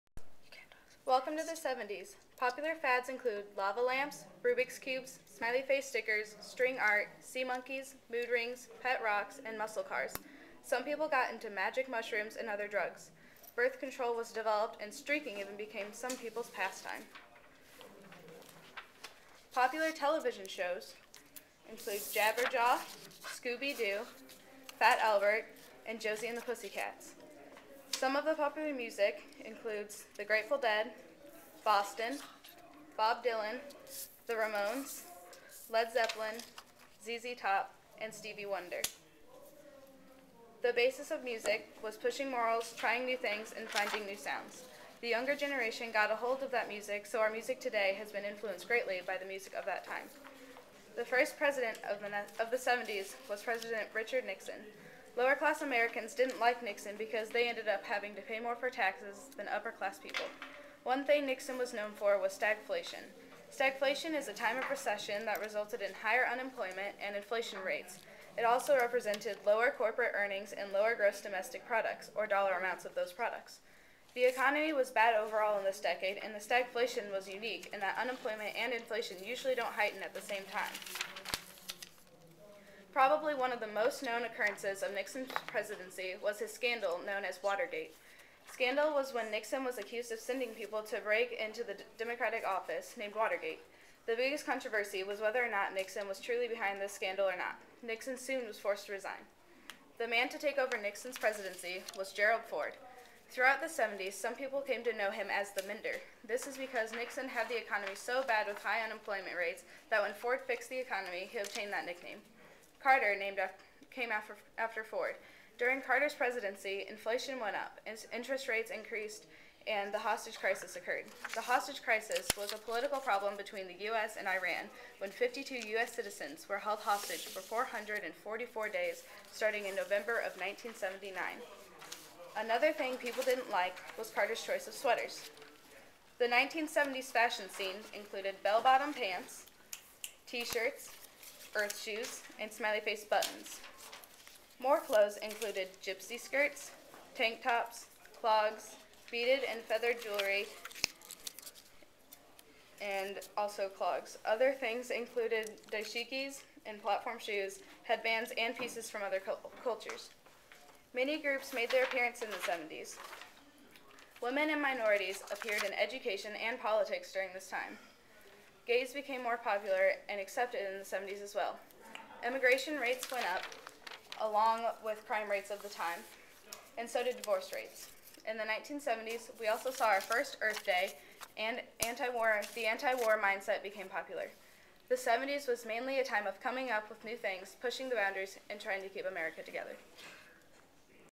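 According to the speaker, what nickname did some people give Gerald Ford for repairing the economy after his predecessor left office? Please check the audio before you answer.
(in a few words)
the Mender.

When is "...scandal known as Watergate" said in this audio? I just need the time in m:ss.
1:26.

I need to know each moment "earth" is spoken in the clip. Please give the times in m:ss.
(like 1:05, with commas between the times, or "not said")
2:21, 3:00.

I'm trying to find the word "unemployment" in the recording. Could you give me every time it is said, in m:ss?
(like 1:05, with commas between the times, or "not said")
1:06, 1:18, 1:48.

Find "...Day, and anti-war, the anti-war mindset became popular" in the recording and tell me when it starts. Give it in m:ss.
3:00.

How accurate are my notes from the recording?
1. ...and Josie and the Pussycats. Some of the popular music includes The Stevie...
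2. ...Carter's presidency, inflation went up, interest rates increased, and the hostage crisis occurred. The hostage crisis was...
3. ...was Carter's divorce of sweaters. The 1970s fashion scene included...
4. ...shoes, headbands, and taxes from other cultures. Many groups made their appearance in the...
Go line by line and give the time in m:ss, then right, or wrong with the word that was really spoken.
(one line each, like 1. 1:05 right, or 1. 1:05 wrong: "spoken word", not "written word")
1. 0:25 wrong: "Grateful", not "Stevie"
2. 1:55 right
3. 2:13 wrong: "choice", not "divorce"
4. 2:37 wrong: "pieces", not "taxes".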